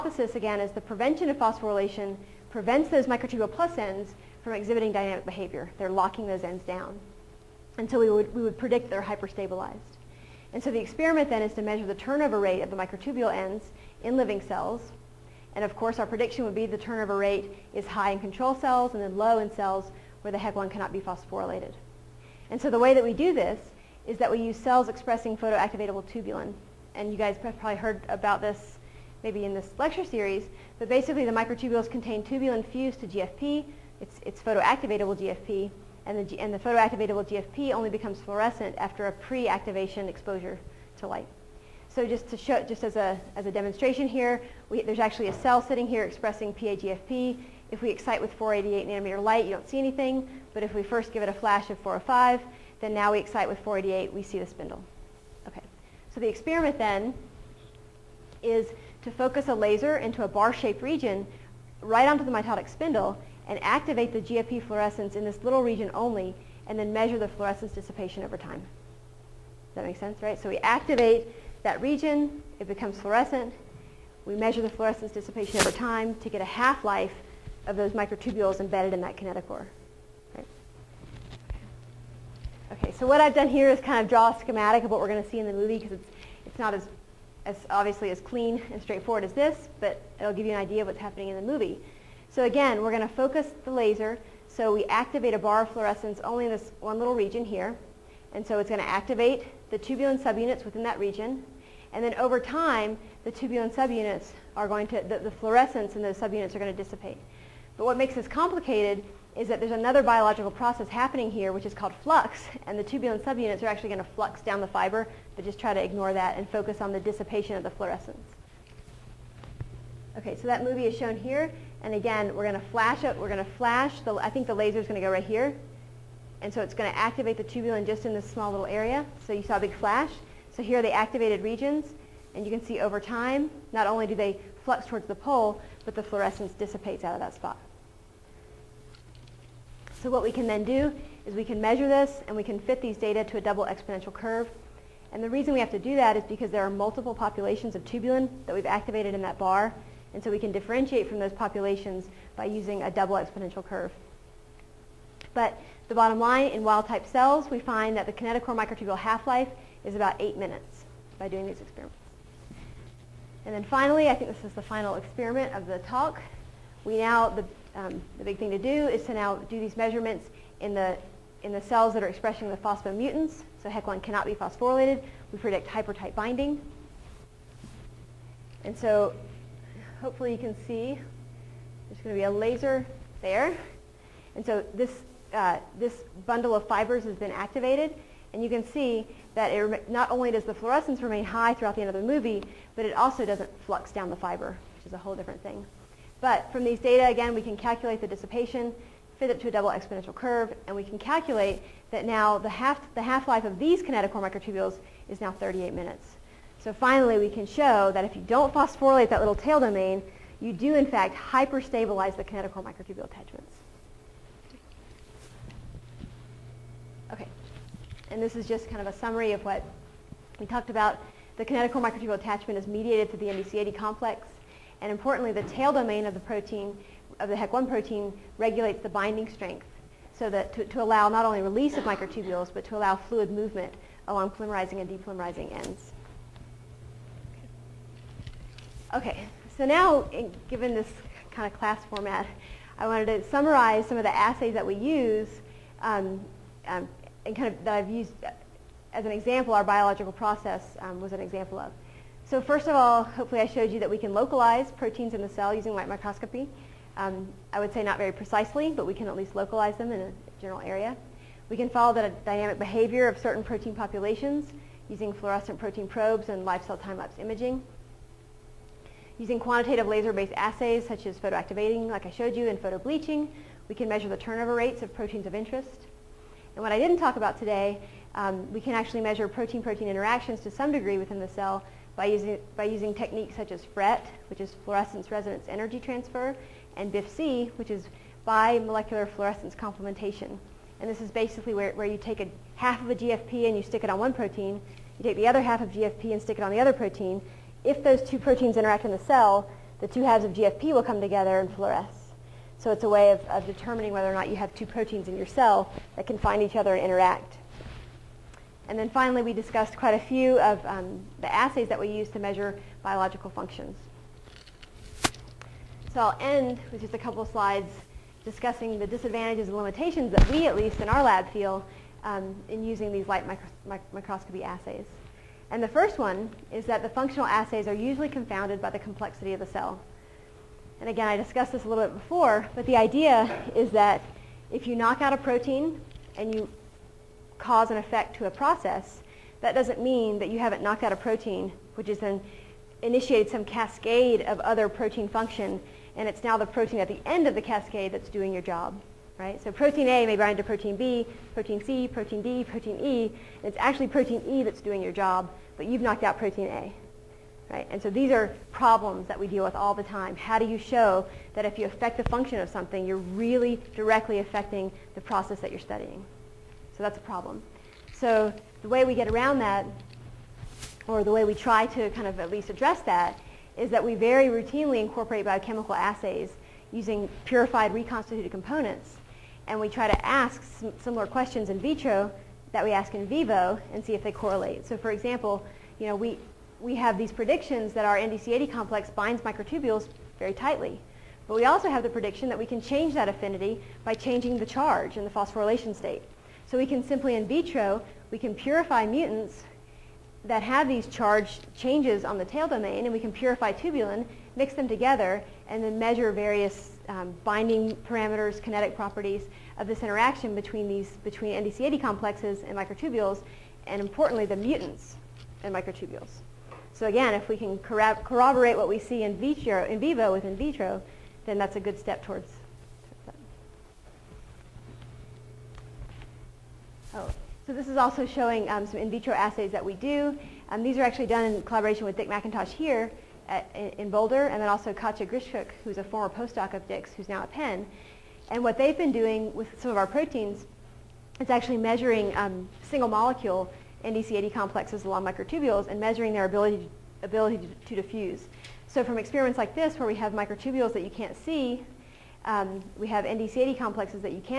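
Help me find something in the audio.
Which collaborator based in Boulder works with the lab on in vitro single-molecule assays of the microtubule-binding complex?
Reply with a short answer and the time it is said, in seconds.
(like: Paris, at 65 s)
Dick McIntosh, at 431 s.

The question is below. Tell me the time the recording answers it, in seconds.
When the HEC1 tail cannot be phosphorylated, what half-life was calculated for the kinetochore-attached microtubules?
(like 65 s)
205 s.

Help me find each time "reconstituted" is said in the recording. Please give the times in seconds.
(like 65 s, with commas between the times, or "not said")
377 s.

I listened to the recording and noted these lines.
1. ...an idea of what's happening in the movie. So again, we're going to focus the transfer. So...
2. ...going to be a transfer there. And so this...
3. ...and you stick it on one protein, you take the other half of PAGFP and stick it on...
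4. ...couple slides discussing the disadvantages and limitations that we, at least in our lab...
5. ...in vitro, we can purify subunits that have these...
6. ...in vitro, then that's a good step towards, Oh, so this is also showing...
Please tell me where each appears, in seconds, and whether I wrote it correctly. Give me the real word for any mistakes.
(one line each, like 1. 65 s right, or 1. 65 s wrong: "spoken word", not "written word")
1. 90 s wrong: "laser", not "transfer"
2. 182 s wrong: "laser", not "transfer"
3. 293 s wrong: "GFP", not "PAGFP"
4. 316 s right
5. 397 s wrong: "mutants", not "subunits"
6. 420 s right.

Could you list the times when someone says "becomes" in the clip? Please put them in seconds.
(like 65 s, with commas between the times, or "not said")
37 s, 72 s.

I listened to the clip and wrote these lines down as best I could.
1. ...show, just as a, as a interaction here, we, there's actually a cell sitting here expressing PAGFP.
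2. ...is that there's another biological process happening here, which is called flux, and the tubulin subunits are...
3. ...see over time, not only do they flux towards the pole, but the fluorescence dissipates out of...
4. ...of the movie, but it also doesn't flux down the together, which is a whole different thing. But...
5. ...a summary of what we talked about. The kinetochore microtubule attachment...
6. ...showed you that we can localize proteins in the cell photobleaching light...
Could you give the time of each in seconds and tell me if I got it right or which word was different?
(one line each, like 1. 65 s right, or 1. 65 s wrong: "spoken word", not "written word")
1. 42 s wrong: "demonstration", not "interaction"
2. 109 s right
3. 132 s right
4. 191 s wrong: "fiber", not "together"
5. 218 s right
6. 253 s wrong: "using", not "photobleaching".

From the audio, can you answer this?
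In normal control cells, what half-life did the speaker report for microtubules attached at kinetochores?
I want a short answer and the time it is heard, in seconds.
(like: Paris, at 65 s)
8 minutes, at 160 s.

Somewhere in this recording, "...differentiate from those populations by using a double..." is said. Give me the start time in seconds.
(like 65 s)
150 s.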